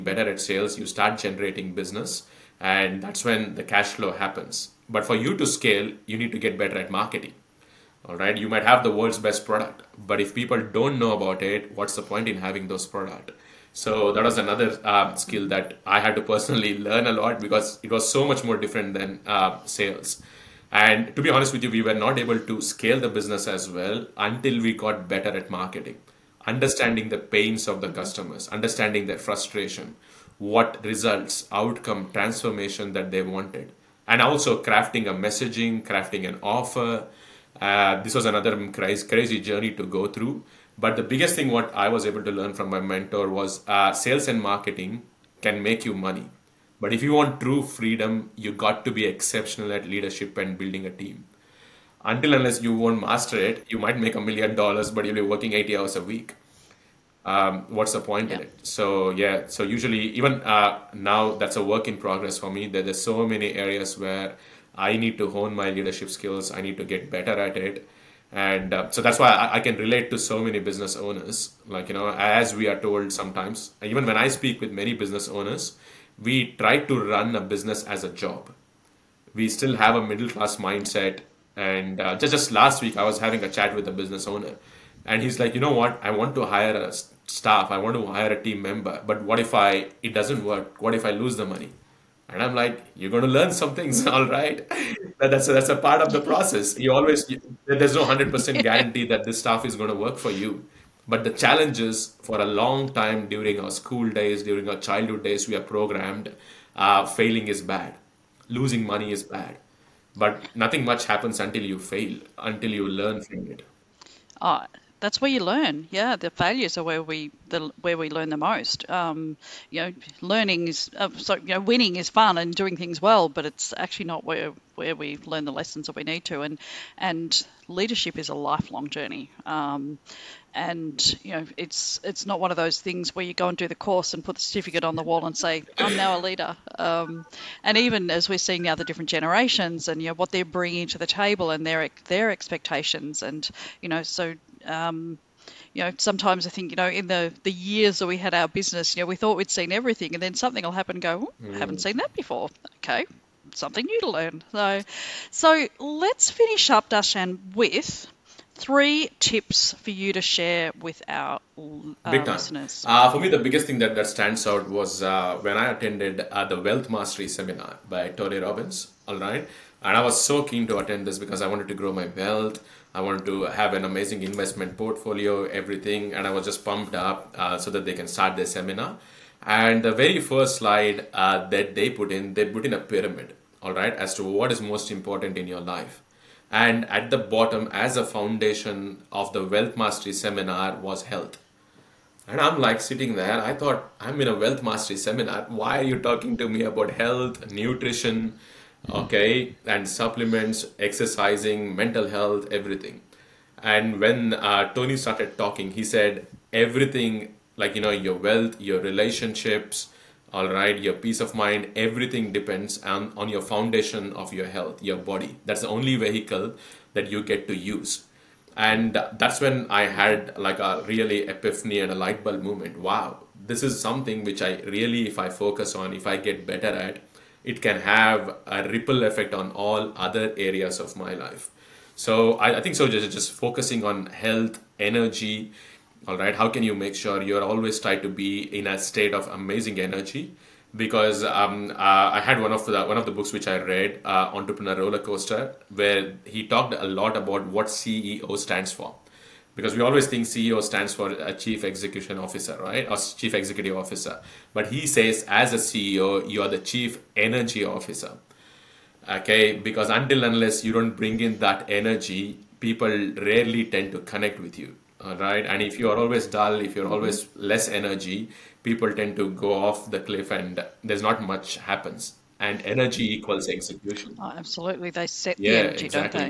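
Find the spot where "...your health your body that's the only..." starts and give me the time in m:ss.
3:34.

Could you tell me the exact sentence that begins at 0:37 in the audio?
Uh, this was another crazy, crazy journey to go through.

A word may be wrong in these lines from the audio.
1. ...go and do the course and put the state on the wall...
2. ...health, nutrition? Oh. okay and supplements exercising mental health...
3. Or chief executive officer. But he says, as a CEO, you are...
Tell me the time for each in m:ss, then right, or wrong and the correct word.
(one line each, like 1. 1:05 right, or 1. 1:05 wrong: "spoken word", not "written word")
1. 2:13 wrong: "certificate", not "state"
2. 3:16 right
3. 4:12 right.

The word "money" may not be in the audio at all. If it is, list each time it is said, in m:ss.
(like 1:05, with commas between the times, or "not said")
0:45, 1:31, 1:48.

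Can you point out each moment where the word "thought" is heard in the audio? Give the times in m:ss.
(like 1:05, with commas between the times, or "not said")
2:29, 3:13.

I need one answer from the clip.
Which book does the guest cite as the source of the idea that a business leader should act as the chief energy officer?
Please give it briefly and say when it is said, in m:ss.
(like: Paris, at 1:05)
Entrepreneur Roller Coaster, at 4:04.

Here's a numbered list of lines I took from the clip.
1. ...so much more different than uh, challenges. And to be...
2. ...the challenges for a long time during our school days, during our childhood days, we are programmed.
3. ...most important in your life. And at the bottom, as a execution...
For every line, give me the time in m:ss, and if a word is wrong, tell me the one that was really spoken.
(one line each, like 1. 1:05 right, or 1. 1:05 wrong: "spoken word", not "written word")
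1. 0:18 wrong: "sales", not "challenges"
2. 1:41 right
3. 3:04 wrong: "foundation", not "execution".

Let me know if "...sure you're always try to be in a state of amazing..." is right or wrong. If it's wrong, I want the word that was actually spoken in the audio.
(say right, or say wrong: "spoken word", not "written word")
right.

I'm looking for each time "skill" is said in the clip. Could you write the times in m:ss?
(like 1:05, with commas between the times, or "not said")
0:15, 1:06.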